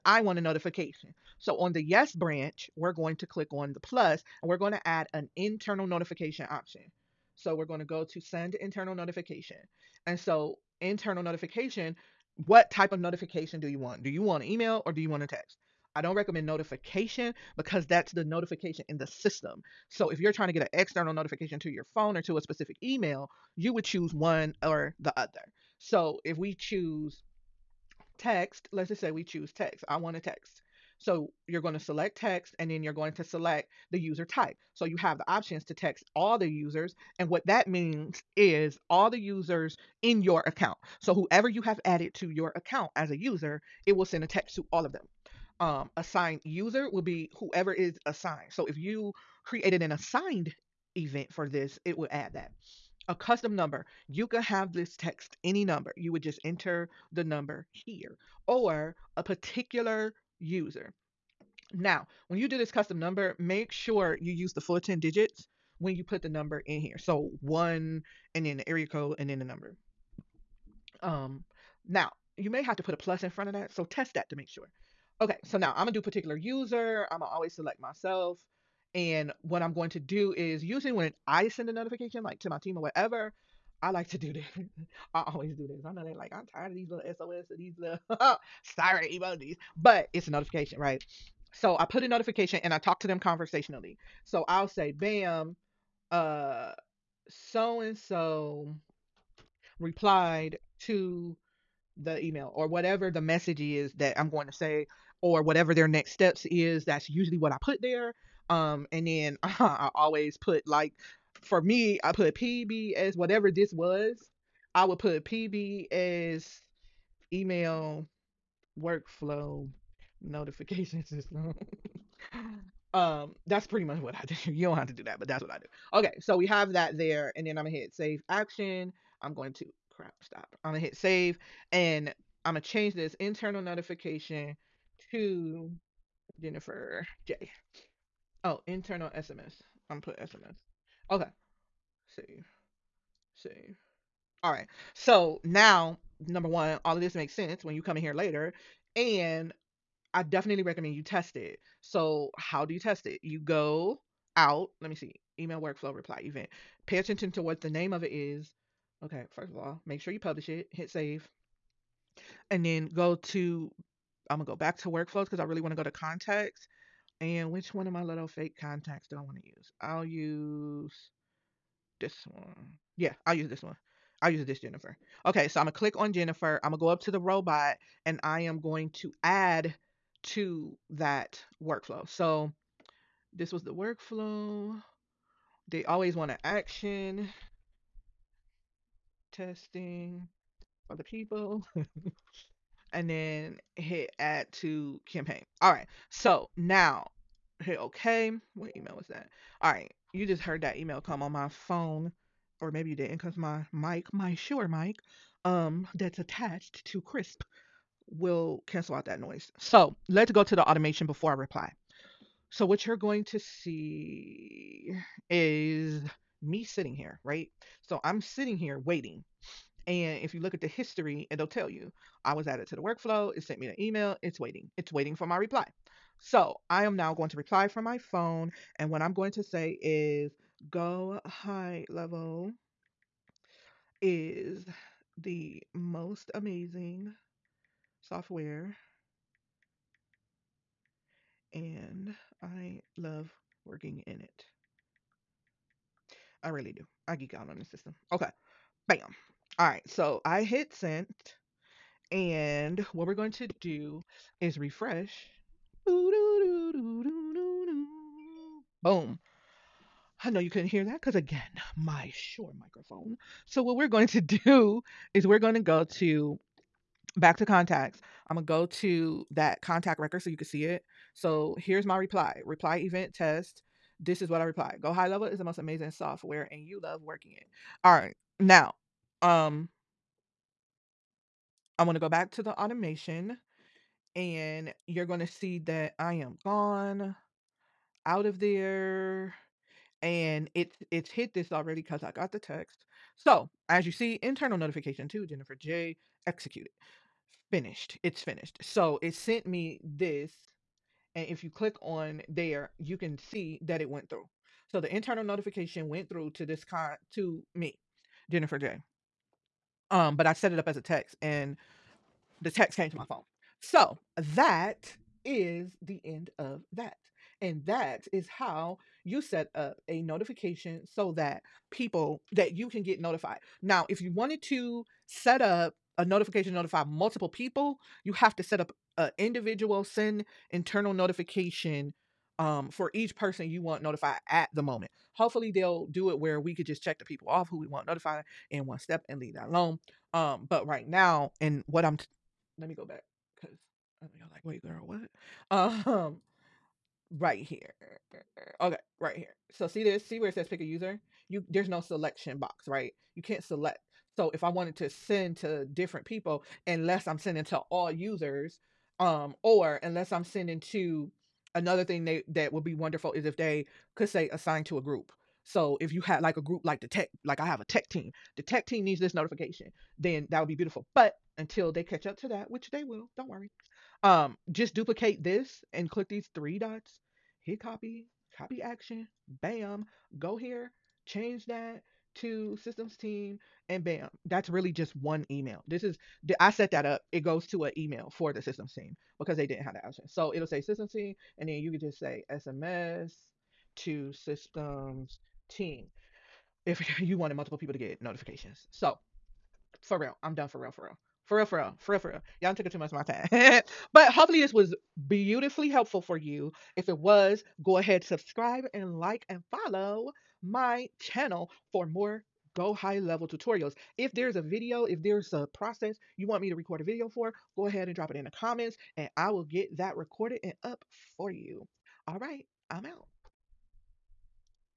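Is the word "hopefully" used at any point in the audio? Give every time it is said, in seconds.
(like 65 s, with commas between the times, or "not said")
335 s, 404 s.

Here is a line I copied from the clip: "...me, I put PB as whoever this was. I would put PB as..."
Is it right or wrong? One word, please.
wrong.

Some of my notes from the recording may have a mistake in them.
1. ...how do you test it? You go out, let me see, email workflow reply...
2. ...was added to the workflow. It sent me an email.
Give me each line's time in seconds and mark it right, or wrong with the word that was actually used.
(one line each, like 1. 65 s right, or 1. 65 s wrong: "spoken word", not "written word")
1. 152 s right
2. 222 s right.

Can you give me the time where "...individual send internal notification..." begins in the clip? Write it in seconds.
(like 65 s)
329 s.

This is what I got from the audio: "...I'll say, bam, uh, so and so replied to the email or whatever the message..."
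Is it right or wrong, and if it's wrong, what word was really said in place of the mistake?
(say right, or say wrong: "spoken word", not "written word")
right.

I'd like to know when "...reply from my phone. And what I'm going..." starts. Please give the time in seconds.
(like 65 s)
227 s.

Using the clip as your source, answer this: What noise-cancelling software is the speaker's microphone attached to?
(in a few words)
Krisp.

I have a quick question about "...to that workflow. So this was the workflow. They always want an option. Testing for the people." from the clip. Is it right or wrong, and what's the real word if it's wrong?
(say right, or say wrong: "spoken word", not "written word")
wrong: "action", not "option".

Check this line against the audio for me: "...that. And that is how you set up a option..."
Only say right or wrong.
wrong.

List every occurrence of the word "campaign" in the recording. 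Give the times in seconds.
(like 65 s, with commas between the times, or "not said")
195 s.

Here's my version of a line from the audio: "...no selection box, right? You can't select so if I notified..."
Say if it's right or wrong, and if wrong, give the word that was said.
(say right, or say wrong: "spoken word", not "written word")
wrong: "wanted", not "notified".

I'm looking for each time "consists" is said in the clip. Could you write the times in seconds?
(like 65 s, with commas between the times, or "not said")
not said.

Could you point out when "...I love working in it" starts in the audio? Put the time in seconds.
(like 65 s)
242 s.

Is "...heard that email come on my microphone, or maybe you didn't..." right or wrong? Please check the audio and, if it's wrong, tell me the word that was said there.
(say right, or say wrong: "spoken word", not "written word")
wrong: "phone", not "microphone".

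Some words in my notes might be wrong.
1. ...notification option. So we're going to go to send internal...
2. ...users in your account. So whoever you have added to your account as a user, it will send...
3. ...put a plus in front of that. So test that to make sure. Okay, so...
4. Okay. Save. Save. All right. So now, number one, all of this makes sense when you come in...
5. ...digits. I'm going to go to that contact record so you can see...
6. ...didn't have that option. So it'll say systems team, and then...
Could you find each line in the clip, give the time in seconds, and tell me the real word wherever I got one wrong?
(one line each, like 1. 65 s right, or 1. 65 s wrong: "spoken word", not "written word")
1. 5 s right
2. 39 s right
3. 72 s right
4. 141 s right
5. 267 s wrong: "contacts", not "digits"
6. 389 s right.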